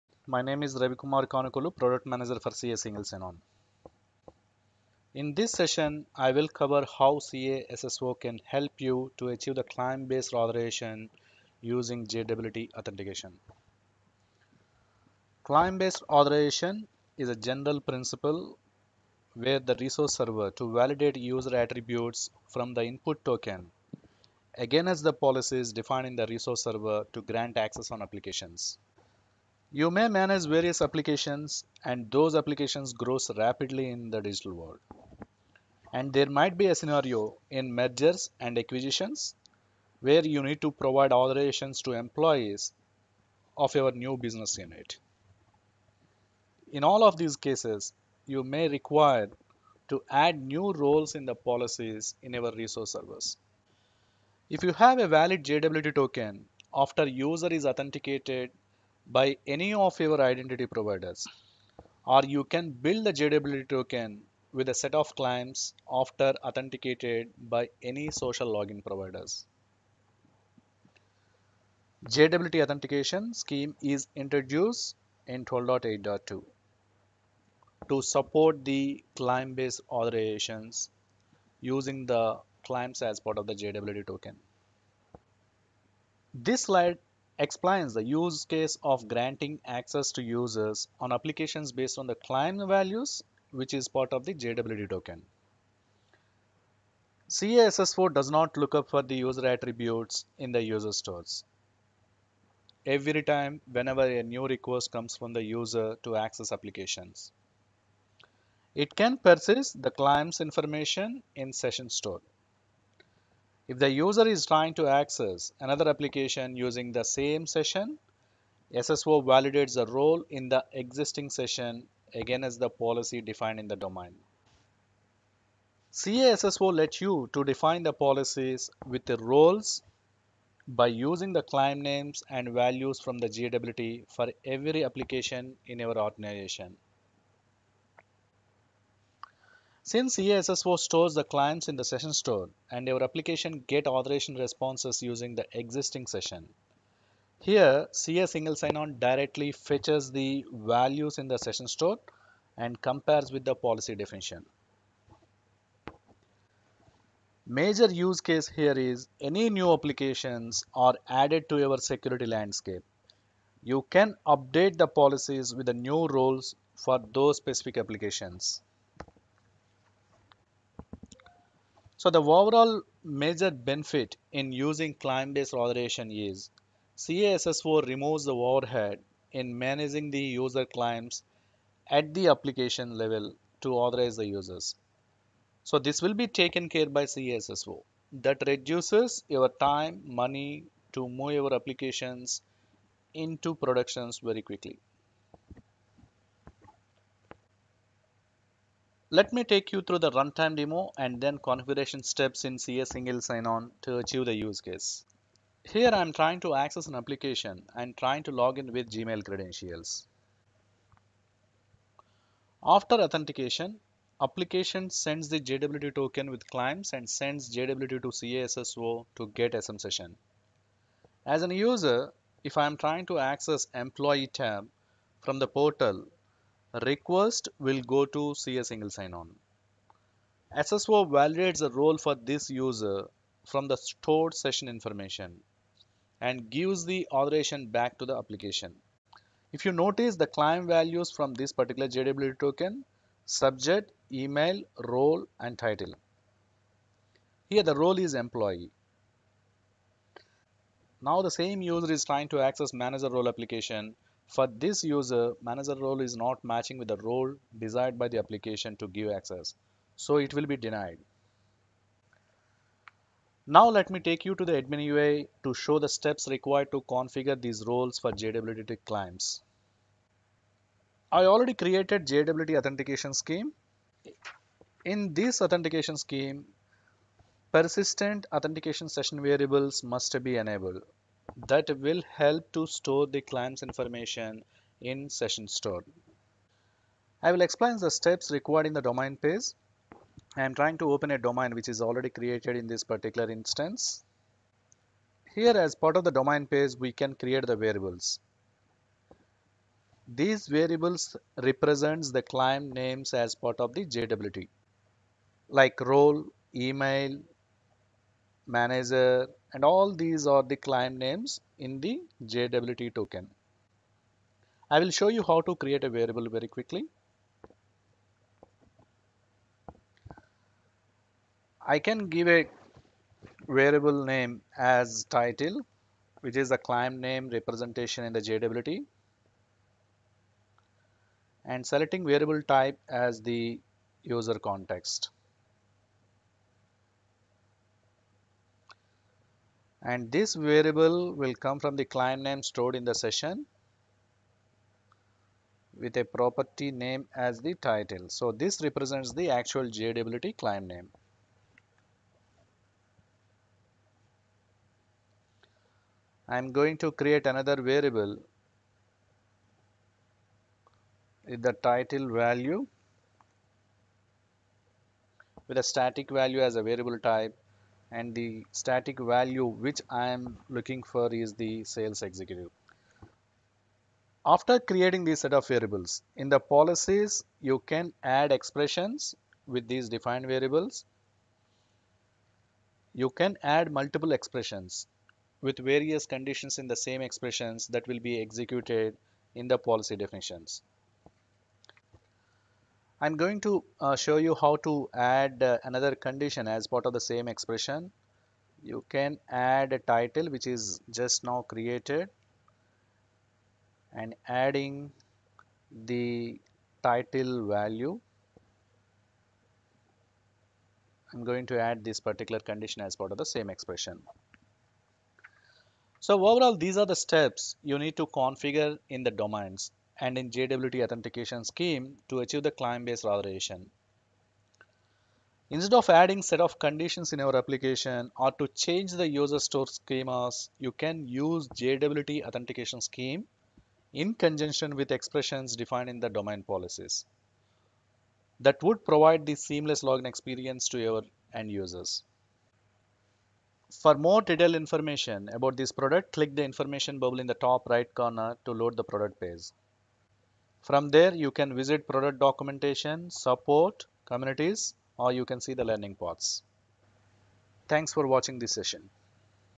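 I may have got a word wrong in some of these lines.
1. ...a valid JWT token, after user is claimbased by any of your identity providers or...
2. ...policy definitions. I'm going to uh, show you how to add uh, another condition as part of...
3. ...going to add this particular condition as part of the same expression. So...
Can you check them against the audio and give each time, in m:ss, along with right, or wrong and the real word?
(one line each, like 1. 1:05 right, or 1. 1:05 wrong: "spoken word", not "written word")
1. 0:54 wrong: "authenticated", not "claimbased"
2. 6:29 right
3. 6:51 right.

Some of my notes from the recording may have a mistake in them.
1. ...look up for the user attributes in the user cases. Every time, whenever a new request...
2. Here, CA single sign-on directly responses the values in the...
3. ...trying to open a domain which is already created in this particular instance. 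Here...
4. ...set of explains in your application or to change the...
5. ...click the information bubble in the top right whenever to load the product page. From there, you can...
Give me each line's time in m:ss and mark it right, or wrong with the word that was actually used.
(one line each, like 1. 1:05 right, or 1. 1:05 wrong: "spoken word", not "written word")
1. 1:38 wrong: "stores", not "cases"
2. 2:27 wrong: "fetches", not "responses"
3. 4:50 right
4. 7:06 wrong: "conditions", not "explains"
5. 7:26 wrong: "corner", not "whenever".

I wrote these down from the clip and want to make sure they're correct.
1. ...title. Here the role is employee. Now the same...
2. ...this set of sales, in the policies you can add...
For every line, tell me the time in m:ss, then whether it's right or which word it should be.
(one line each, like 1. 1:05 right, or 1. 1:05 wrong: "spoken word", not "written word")
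1. 4:05 right
2. 6:15 wrong: "variables", not "sales".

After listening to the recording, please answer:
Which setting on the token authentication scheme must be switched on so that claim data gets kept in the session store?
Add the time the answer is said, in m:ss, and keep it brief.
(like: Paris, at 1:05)
persistent authentication session variables, at 4:37.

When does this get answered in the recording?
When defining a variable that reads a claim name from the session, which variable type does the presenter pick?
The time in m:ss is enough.
5:34.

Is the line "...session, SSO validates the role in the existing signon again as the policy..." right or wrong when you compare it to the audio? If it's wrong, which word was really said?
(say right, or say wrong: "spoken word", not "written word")
wrong: "session", not "signon".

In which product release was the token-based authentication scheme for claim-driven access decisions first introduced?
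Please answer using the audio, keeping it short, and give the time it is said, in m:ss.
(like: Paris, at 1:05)
12.8.2, at 1:15.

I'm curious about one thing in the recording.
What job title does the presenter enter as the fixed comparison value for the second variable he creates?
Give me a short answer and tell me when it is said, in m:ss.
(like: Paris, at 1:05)
sales executive, at 6:11.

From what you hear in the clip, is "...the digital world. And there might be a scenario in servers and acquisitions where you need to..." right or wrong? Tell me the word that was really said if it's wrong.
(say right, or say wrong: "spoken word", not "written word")
wrong: "mergers", not "servers".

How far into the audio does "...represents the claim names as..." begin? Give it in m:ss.
5:01.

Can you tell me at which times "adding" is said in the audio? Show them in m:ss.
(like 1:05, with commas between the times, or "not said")
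6:44, 7:05.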